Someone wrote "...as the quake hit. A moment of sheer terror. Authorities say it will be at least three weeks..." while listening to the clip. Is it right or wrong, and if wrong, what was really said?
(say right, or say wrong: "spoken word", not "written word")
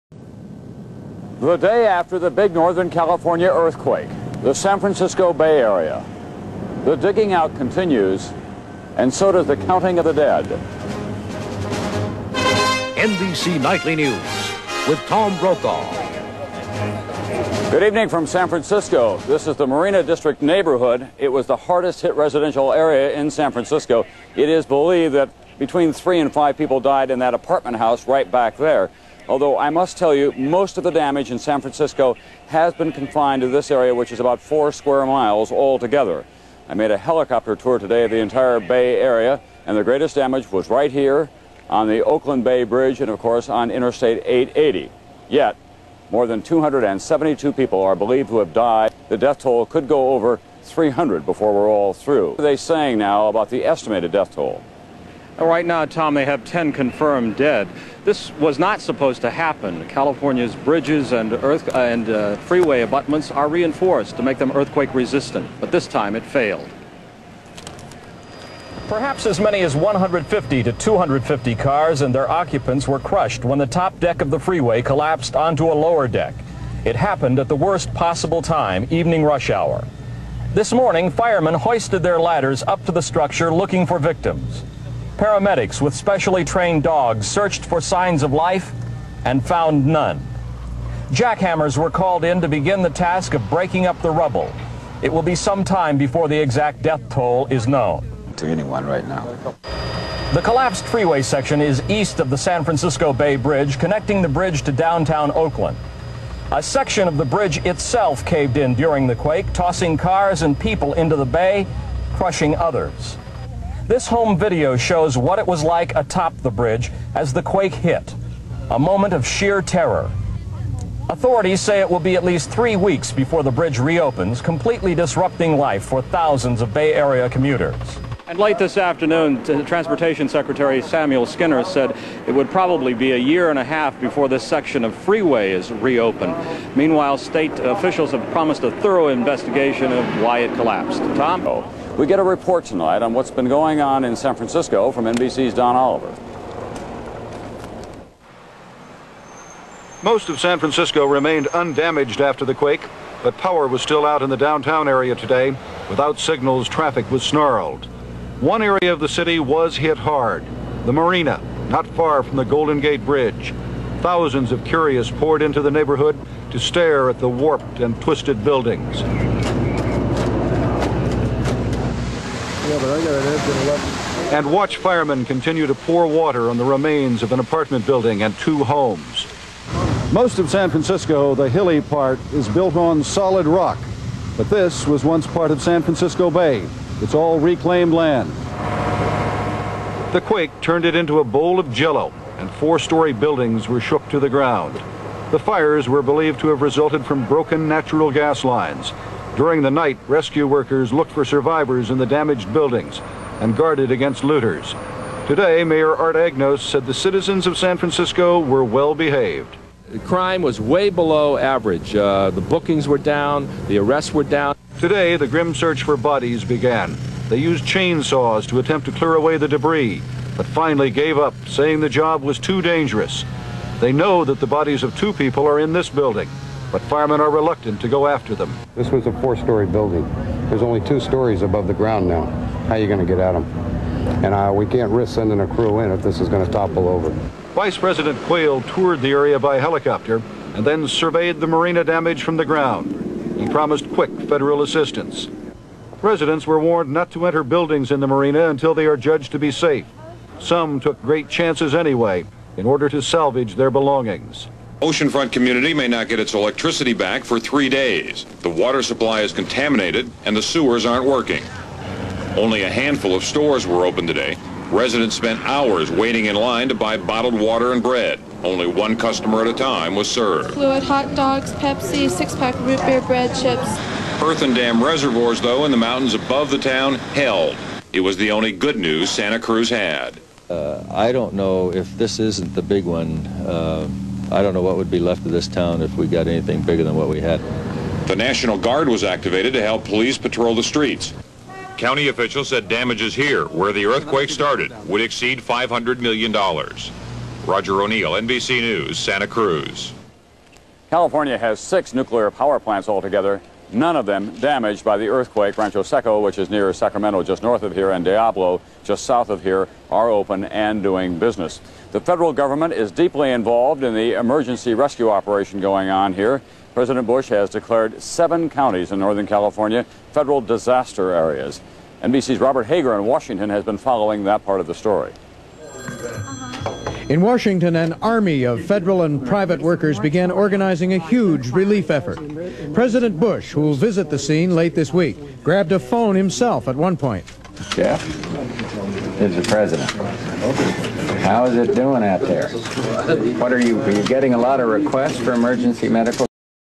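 right.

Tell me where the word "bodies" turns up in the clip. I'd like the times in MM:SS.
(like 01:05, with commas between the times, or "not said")
03:35, 03:44.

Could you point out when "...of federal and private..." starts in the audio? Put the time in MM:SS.
05:28.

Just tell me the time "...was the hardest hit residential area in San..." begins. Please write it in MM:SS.
00:21.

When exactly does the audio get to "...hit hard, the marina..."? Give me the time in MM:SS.
02:39.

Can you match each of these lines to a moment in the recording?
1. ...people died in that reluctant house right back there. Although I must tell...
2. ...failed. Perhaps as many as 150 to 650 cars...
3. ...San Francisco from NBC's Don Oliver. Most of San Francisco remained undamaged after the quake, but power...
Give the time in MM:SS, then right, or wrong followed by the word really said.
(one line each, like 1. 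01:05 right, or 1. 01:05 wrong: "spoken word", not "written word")
1. 00:26 wrong: "apartment", not "reluctant"
2. 01:06 wrong: "250", not "650"
3. 02:24 right.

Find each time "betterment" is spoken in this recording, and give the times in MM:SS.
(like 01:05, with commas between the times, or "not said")
not said.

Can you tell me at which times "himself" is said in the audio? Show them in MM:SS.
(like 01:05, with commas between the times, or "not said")
05:36.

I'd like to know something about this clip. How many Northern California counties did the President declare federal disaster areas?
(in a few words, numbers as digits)
7.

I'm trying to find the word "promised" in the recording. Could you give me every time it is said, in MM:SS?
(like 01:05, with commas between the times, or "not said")
02:18, 04:03.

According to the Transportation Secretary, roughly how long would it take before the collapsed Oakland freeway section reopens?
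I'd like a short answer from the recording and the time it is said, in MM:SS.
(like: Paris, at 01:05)
a year and a half, at 02:13.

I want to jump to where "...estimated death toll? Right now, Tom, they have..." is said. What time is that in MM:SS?
00:53.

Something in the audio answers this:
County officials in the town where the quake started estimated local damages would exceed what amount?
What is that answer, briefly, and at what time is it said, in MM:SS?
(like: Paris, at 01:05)
$500 million, at 04:55.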